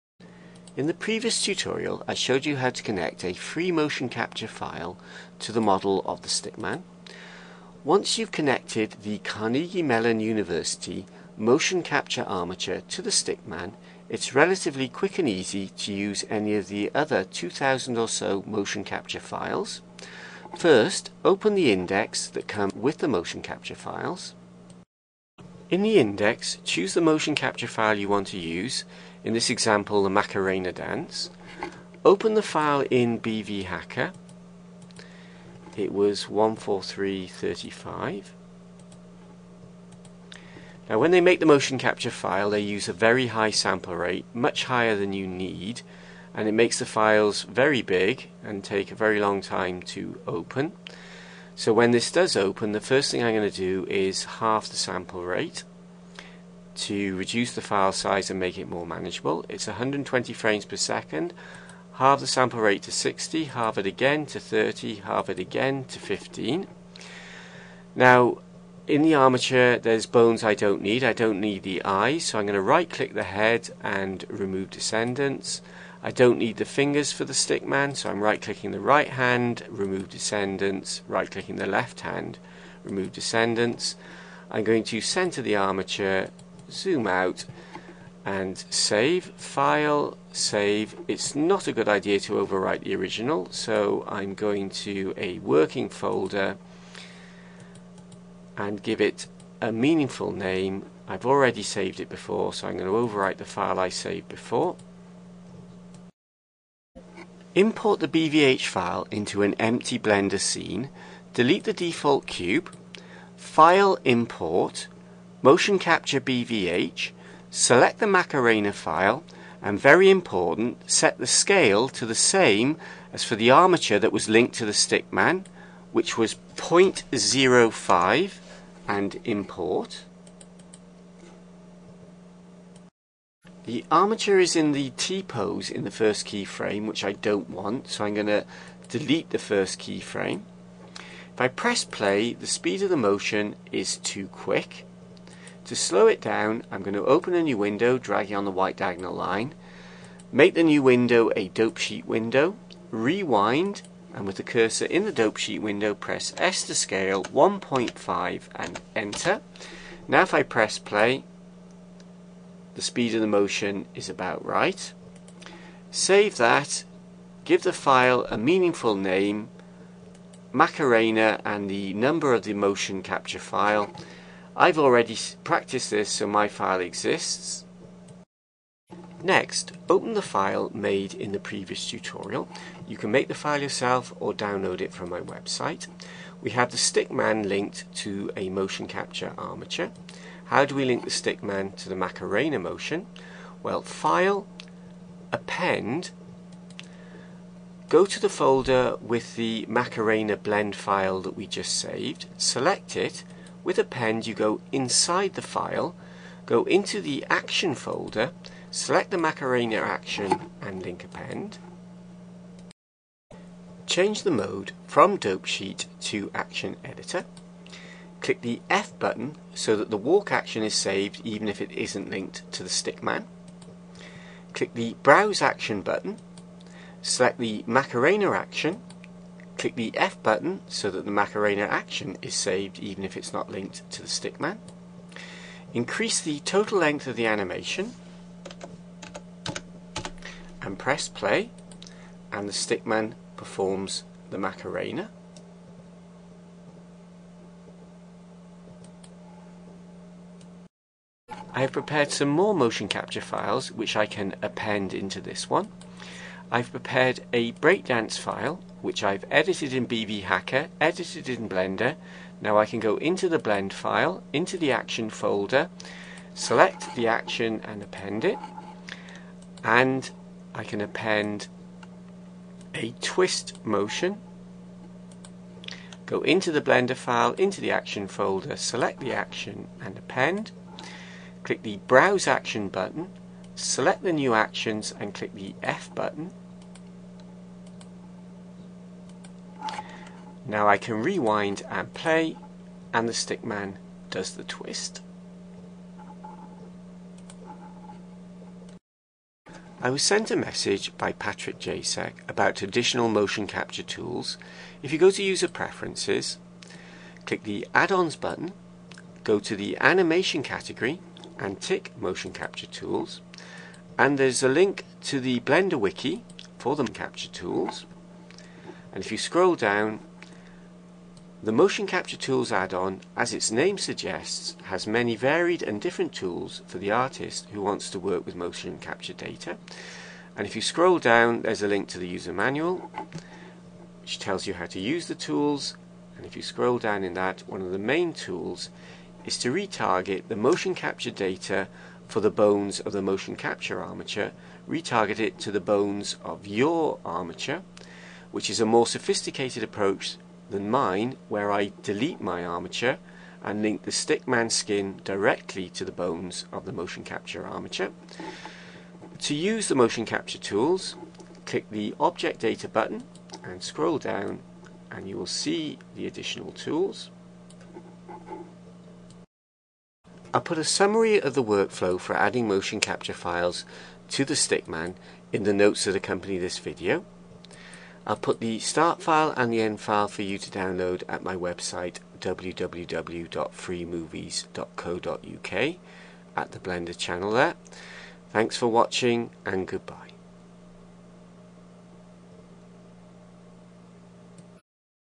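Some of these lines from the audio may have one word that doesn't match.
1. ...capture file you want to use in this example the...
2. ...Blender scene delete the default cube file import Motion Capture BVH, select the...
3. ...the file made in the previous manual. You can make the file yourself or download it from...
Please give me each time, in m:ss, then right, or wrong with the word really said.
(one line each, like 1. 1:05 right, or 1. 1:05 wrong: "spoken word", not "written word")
1. 0:27 right
2. 1:49 right
3. 3:00 wrong: "tutorial", not "manual".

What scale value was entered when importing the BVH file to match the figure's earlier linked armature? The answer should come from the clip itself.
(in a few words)
0.05.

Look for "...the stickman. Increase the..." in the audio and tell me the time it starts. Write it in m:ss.
3:54.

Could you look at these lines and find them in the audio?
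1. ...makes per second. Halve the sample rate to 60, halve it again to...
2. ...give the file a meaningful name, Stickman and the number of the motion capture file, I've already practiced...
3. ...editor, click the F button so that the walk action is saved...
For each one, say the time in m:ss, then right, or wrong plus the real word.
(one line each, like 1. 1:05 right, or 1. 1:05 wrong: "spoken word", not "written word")
1. 1:00 wrong: "frames", not "makes"
2. 2:47 wrong: "Macarena", not "Stickman"
3. 3:36 right.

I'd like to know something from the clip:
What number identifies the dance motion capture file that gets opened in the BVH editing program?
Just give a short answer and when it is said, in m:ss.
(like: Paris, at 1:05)
14335, at 0:36.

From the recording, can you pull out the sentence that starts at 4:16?
I've prepared a breakdance file which I've edited in BVHacker, edited in Blender.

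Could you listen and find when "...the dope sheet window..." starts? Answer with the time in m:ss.
2:35.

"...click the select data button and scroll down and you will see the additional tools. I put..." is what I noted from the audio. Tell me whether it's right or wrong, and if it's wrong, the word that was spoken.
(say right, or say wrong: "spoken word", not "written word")
wrong: "object", not "select".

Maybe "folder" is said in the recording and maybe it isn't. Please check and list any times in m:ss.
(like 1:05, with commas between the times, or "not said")
1:35, 3:18, 3:27, 4:25, 4:38.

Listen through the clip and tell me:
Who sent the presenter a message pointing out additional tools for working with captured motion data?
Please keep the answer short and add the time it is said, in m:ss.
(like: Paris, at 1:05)
Patrick Jasek, at 5:01.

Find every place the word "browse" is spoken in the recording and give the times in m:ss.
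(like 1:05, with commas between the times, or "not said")
3:45, 4:41.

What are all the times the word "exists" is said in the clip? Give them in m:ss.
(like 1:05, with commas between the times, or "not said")
2:56.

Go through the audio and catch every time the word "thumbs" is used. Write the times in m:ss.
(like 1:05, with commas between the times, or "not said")
not said.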